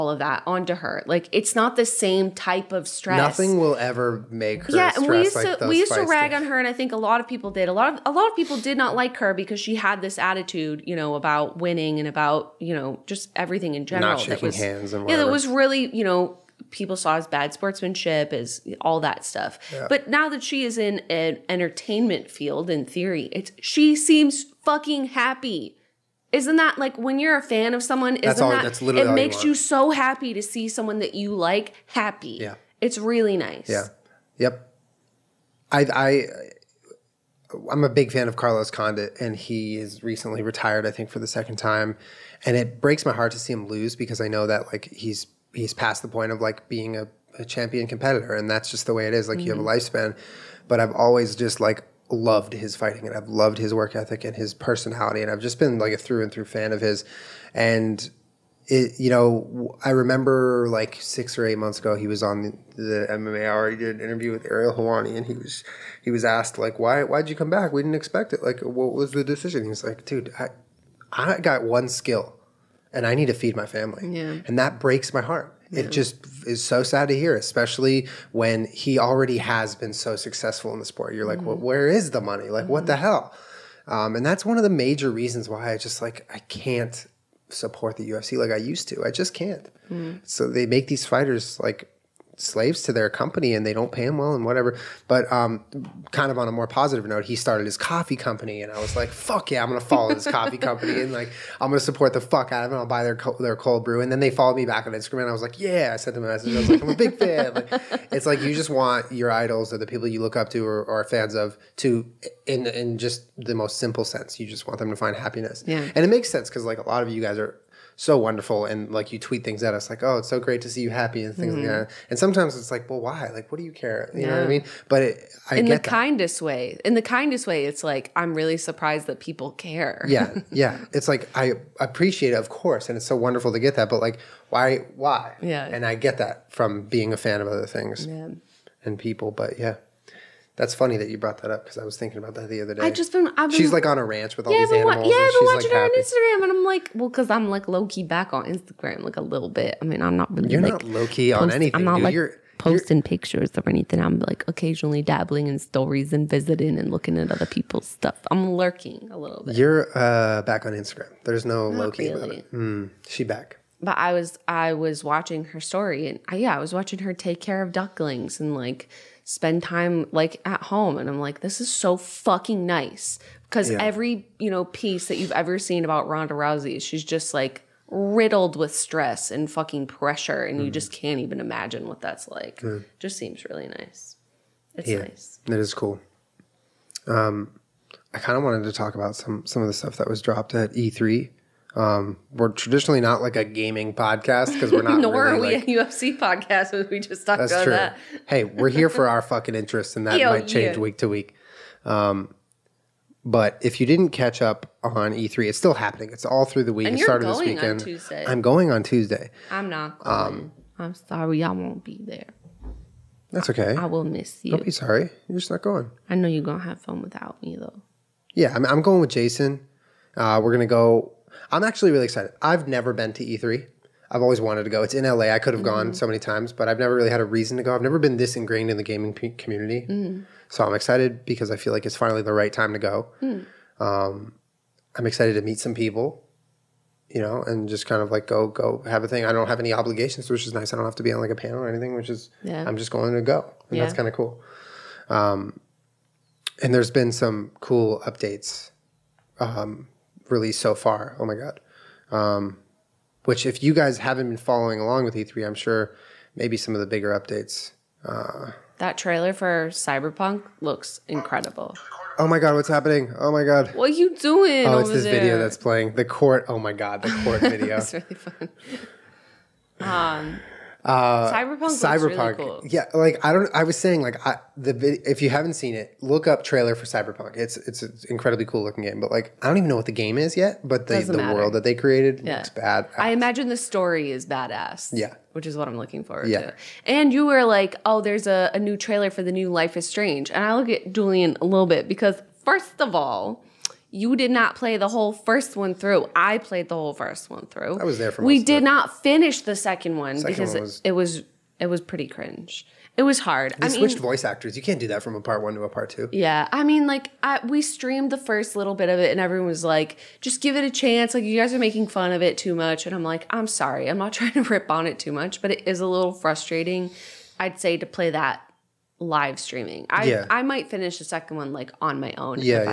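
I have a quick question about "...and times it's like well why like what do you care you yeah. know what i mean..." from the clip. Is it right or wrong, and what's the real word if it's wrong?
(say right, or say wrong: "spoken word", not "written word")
wrong: "sometimes", not "times".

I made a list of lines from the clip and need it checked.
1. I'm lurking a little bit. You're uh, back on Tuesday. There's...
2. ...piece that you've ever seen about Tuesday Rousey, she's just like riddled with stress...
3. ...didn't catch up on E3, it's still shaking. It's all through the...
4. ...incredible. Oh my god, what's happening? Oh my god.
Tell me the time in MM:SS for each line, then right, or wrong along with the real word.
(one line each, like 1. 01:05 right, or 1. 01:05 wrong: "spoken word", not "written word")
1. 02:38 wrong: "Instagram", not "Tuesday"
2. 02:54 wrong: "Ronda", not "Tuesday"
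3. 03:23 wrong: "happening", not "shaking"
4. 04:21 right.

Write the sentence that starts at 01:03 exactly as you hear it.
He did an interview with Ariel Helwani, and he was he was asked like, "Why why'd you come back?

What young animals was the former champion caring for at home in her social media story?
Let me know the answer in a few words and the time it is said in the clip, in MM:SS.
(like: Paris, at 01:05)
ducklings, at 02:47.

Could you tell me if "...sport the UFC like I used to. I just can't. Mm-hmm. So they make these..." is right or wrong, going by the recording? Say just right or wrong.
wrong.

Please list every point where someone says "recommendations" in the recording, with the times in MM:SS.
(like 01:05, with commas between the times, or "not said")
not said.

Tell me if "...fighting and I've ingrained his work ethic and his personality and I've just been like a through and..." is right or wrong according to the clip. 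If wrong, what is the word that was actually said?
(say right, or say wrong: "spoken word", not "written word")
wrong: "loved", not "ingrained".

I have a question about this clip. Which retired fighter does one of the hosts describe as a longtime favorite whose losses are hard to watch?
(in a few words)
Carlos Condit.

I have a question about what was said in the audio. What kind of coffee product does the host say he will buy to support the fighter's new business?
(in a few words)
cold brew.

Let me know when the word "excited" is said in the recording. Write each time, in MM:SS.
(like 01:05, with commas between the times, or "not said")
03:42, 03:50, 03:55.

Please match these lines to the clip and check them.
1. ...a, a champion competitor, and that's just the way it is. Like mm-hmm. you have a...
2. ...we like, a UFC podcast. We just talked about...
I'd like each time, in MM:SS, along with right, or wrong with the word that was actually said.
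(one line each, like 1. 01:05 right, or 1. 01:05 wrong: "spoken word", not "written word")
1. 00:46 right
2. 03:15 right.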